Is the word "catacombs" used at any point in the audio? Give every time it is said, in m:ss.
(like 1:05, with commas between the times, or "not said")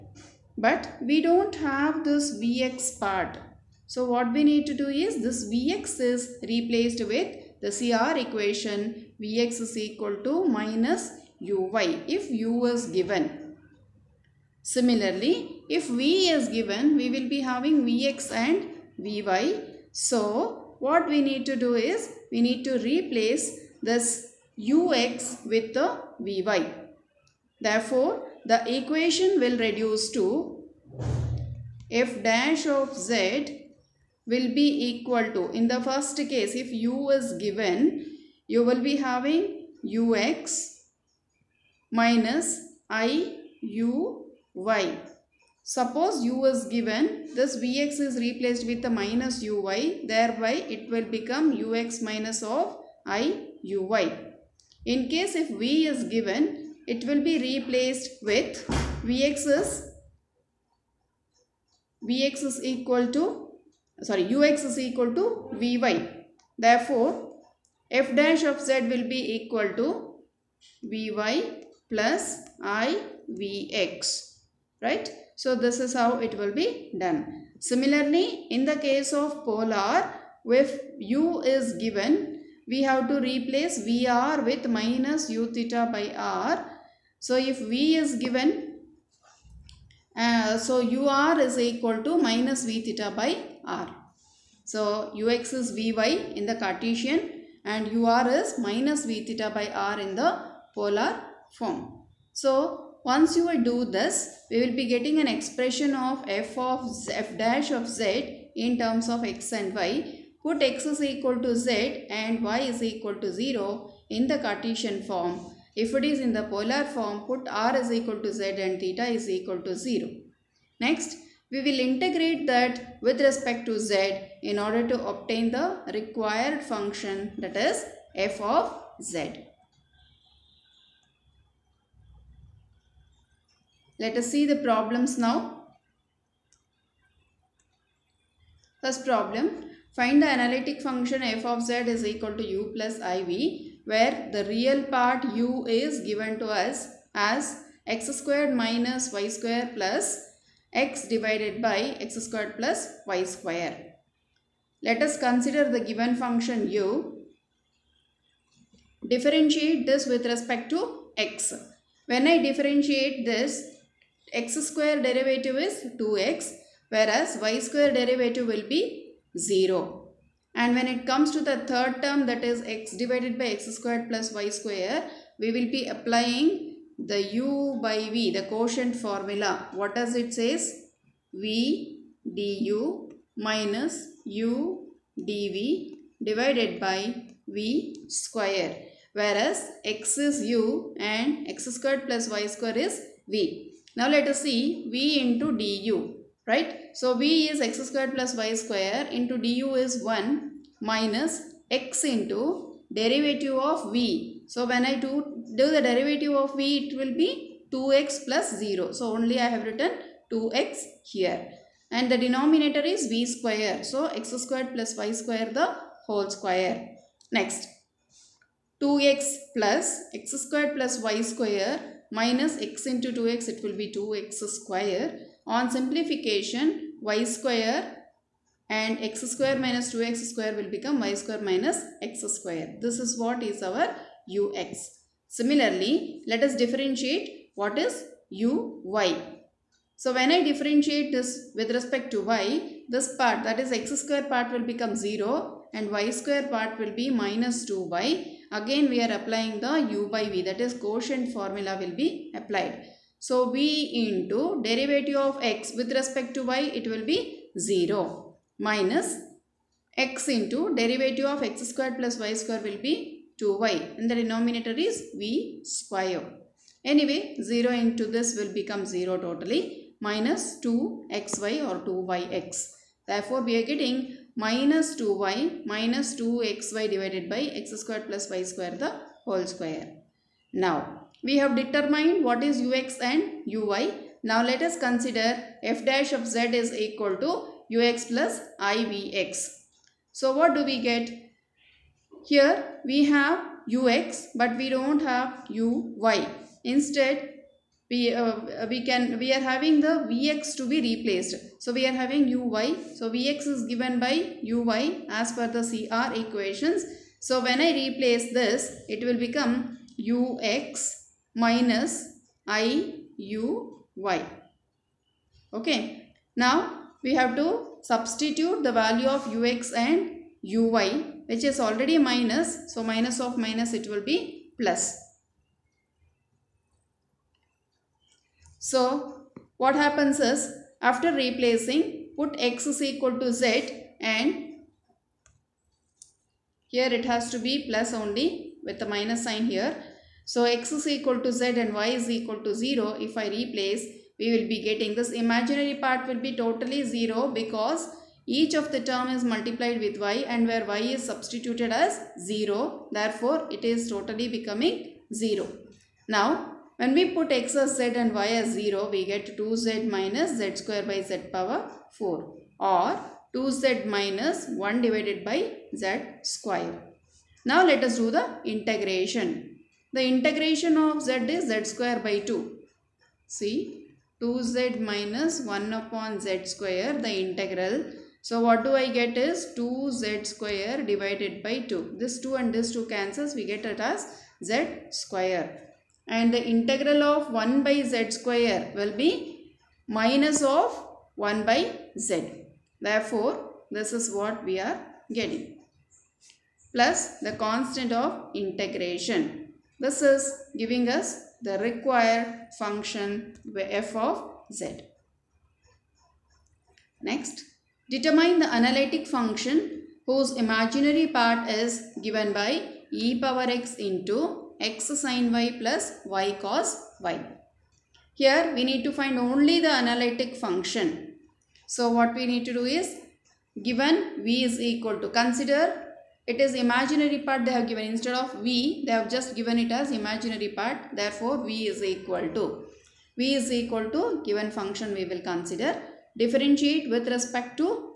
not said.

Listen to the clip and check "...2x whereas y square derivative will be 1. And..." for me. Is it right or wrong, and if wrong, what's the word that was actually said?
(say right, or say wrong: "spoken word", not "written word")
wrong: "0", not "1".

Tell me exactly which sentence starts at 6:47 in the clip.
Next, determine the analytic function whose imaginary part is given by e power x into x sin y plus y cos y.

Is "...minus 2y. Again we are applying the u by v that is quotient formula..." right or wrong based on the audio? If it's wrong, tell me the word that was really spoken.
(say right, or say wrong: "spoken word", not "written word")
right.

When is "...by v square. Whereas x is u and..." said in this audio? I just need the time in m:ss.
3:06.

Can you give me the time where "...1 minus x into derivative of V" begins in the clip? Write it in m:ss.
3:20.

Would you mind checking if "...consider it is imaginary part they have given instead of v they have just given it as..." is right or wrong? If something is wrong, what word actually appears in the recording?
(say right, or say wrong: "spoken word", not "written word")
right.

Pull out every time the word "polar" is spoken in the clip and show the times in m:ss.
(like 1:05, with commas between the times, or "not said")
1:19, 1:40, 1:56.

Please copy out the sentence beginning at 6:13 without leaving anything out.
See 2z minus 1 upon z square the integral.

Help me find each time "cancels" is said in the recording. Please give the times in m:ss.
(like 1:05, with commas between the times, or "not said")
6:22.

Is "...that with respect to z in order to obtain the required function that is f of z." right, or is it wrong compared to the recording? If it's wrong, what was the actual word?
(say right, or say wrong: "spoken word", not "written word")
right.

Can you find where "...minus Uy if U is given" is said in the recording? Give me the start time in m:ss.
0:10.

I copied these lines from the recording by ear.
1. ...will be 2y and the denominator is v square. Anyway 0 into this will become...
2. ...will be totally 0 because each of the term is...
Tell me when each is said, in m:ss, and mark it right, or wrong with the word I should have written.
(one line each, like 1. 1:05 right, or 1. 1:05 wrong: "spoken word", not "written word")
1. 4:22 right
2. 5:46 right.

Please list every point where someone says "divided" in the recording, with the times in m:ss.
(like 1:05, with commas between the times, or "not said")
2:31, 2:52, 3:06, 4:36, 6:04, 6:20.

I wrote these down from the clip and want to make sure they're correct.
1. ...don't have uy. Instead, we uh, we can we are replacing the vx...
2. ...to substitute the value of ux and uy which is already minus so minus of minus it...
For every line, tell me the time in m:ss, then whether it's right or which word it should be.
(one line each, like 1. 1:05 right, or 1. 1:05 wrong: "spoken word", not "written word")
1. 4:54 wrong: "having", not "replacing"
2. 5:17 right.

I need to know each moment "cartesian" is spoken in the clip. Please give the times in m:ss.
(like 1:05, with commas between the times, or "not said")
1:36, 1:54.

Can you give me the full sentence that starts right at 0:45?
Suppose u is given, this vx is replaced with a minus uy, thereby it will become ux minus of i uy.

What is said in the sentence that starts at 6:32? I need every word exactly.
Therefore, this is what we are getting.